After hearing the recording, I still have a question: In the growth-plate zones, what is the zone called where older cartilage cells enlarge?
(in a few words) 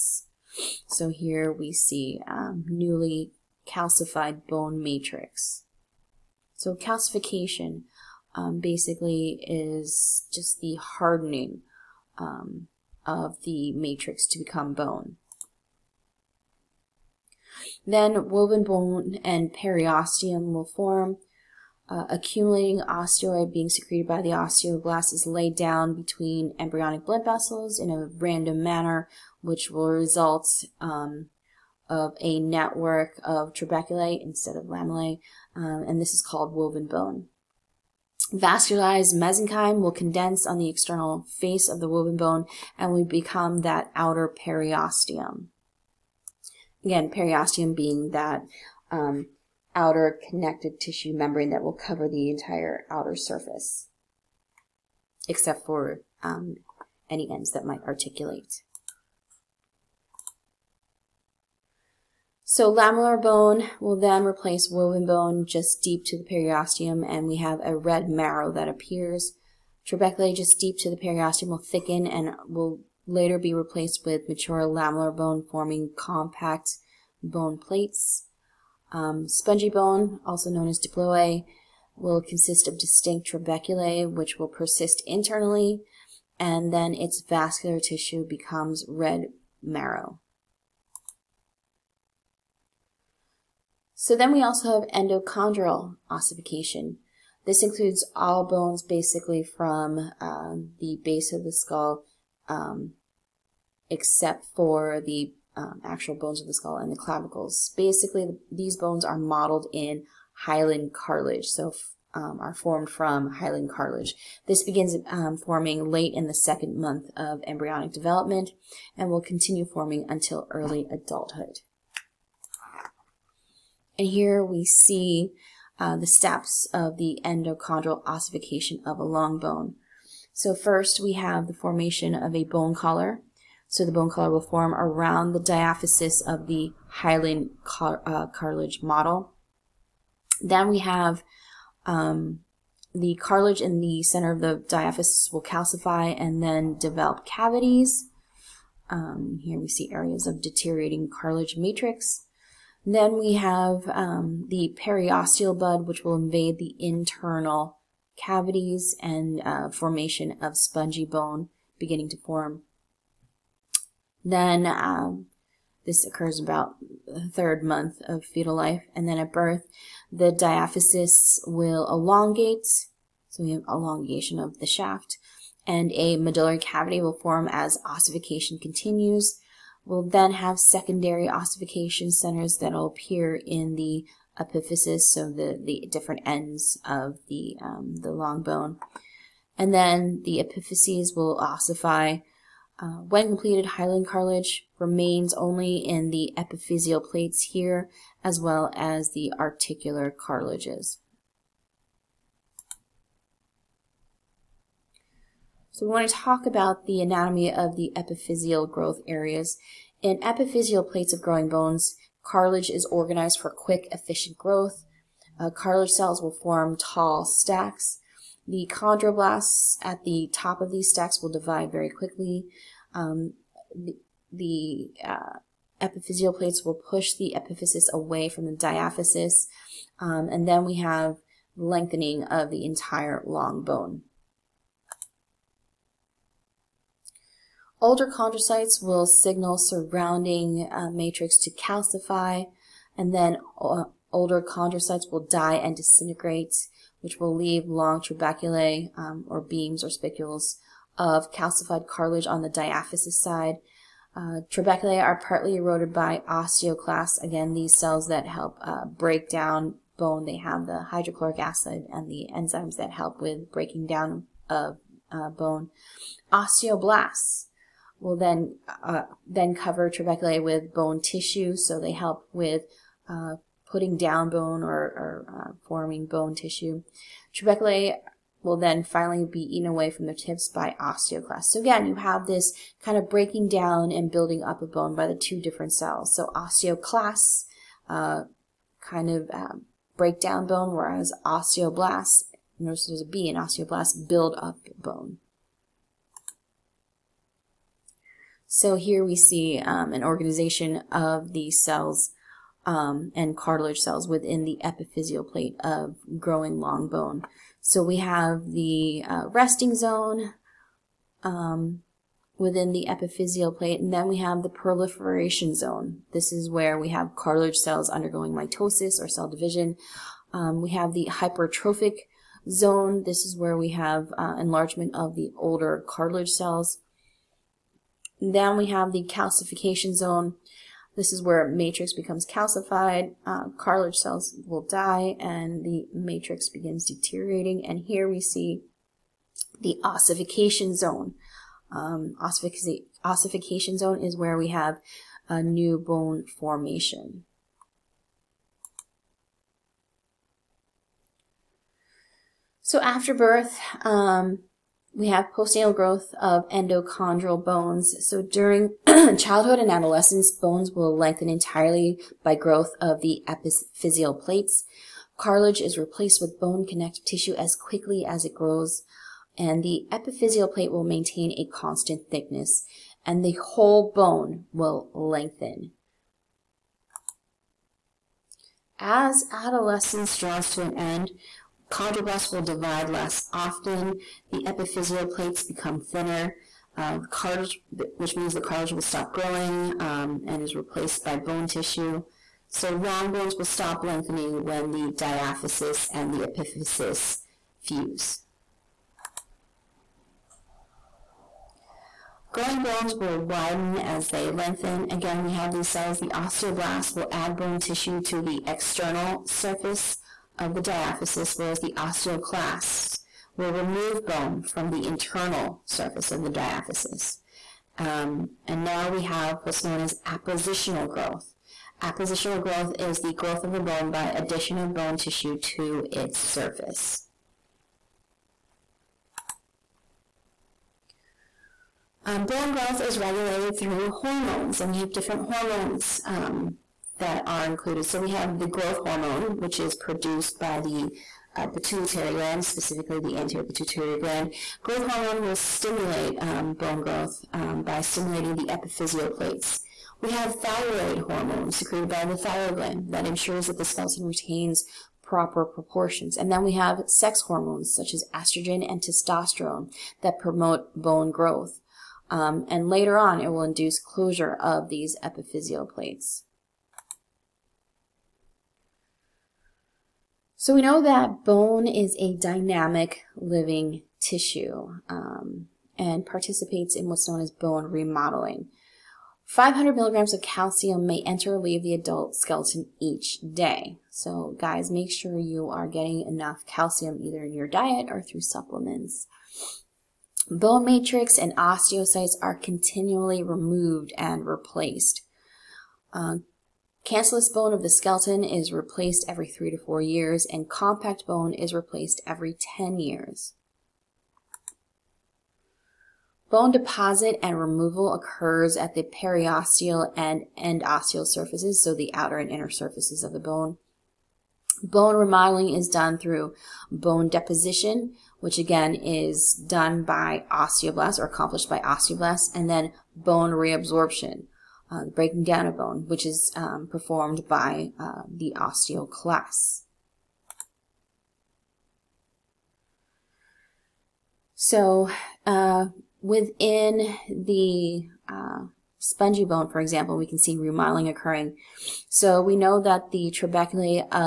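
hypertrophic zone.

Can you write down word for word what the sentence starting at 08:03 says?
So guys, make sure you are getting enough calcium either in your diet or through supplements.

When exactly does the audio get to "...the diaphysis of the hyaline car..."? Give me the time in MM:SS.
02:15.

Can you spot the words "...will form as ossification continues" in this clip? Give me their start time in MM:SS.
02:57.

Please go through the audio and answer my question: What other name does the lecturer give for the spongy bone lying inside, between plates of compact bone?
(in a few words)
diploe.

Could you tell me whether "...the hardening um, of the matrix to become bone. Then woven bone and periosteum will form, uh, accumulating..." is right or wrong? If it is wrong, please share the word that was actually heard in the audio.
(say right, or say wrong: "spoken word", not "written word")
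right.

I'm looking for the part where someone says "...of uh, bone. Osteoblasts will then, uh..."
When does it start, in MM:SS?
04:24.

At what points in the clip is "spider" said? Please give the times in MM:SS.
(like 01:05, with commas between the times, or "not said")
not said.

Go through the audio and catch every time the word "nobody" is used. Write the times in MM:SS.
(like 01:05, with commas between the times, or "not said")
not said.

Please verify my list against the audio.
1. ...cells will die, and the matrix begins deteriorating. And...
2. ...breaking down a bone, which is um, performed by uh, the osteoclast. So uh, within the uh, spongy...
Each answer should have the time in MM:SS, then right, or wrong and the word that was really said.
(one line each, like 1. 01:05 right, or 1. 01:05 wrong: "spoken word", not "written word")
1. 05:33 right
2. 08:44 right.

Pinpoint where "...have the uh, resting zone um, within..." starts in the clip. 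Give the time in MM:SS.
05:07.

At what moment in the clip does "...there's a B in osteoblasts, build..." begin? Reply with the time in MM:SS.
04:52.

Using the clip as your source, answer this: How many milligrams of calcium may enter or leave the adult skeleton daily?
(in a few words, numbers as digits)
500.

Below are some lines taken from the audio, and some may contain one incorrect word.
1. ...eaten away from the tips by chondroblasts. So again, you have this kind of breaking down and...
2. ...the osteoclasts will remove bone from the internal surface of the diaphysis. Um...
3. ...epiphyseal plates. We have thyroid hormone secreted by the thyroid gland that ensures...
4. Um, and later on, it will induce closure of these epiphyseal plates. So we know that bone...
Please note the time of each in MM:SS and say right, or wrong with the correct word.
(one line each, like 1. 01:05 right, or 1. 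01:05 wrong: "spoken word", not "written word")
1. 04:39 wrong: "osteoclasts", not "chondroblasts"
2. 06:51 right
3. 07:28 right
4. 07:42 right.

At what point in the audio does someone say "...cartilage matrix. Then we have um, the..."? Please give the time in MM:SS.
02:31.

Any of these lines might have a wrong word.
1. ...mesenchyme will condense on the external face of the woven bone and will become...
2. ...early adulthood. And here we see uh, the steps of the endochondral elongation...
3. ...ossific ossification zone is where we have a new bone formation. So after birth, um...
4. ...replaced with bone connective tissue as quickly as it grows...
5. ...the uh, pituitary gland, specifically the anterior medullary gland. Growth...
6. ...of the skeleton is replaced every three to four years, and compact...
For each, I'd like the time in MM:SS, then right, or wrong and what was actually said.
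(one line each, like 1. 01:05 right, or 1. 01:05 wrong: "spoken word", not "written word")
1. 00:39 right
2. 02:00 wrong: "ossification", not "elongation"
3. 05:42 right
4. 06:05 right
5. 07:20 wrong: "pituitary", not "medullary"
6. 08:17 right.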